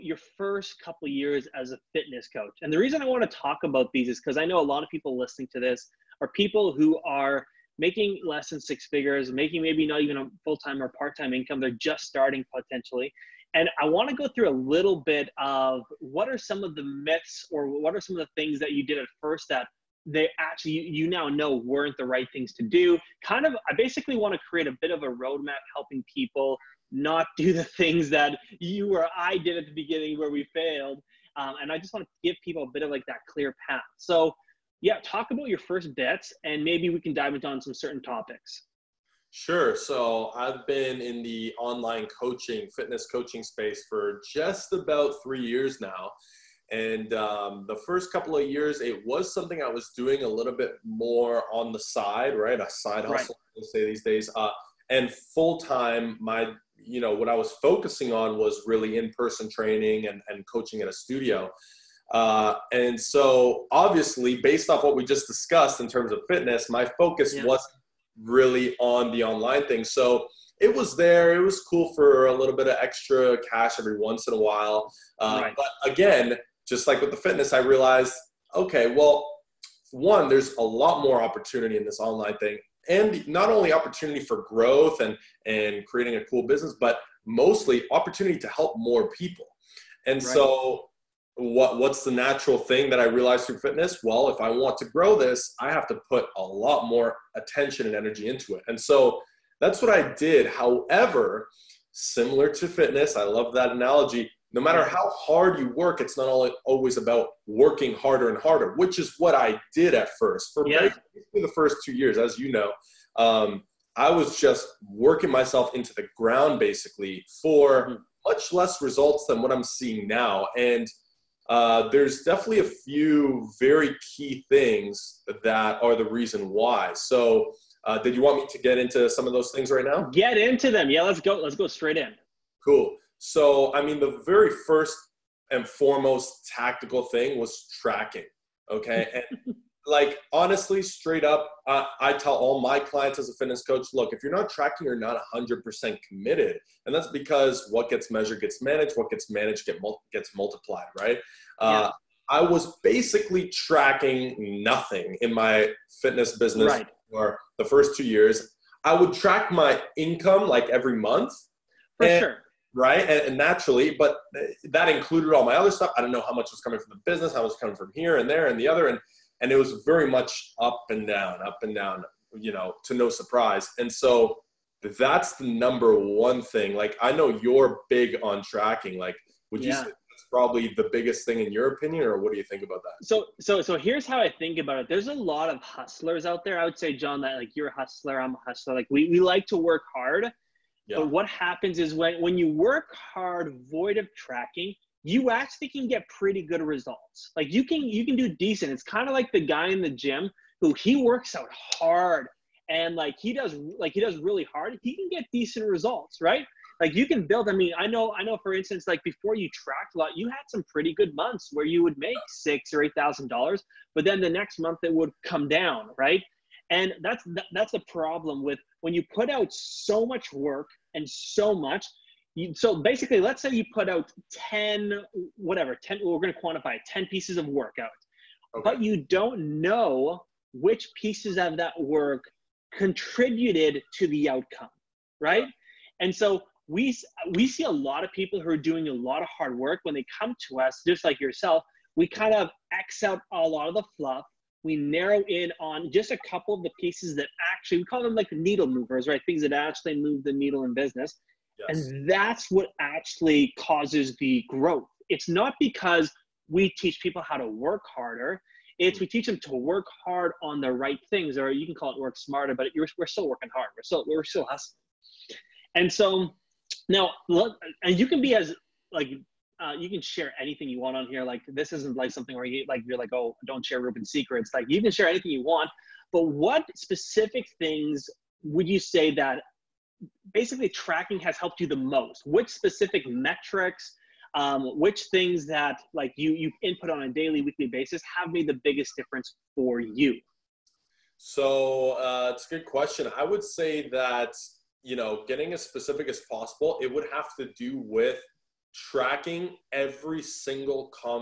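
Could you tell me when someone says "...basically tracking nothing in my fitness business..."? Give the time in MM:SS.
02:32.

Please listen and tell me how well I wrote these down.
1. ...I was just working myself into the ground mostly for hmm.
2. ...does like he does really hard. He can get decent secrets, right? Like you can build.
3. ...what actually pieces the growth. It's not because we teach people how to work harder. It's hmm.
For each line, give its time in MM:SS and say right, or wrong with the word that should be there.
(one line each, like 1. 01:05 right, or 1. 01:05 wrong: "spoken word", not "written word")
1. 01:53 wrong: "basically", not "mostly"
2. 03:23 wrong: "results", not "secrets"
3. 04:12 wrong: "causes", not "pieces".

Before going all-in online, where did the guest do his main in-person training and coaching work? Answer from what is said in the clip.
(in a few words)
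a studio.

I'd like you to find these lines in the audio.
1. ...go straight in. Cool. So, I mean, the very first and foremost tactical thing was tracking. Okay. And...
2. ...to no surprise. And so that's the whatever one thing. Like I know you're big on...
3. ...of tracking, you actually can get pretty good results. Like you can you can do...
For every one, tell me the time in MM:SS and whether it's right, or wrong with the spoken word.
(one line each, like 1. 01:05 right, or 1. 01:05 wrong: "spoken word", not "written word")
1. 02:11 right
2. 02:52 wrong: "number", not "whatever"
3. 03:13 right.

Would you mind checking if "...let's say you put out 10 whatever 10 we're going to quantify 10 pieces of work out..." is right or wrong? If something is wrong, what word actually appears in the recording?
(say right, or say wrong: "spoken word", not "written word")
right.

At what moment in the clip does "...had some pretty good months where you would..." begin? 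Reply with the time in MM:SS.
03:30.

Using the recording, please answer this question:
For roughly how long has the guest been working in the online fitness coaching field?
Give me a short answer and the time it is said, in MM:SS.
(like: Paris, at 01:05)
3 years, at 00:44.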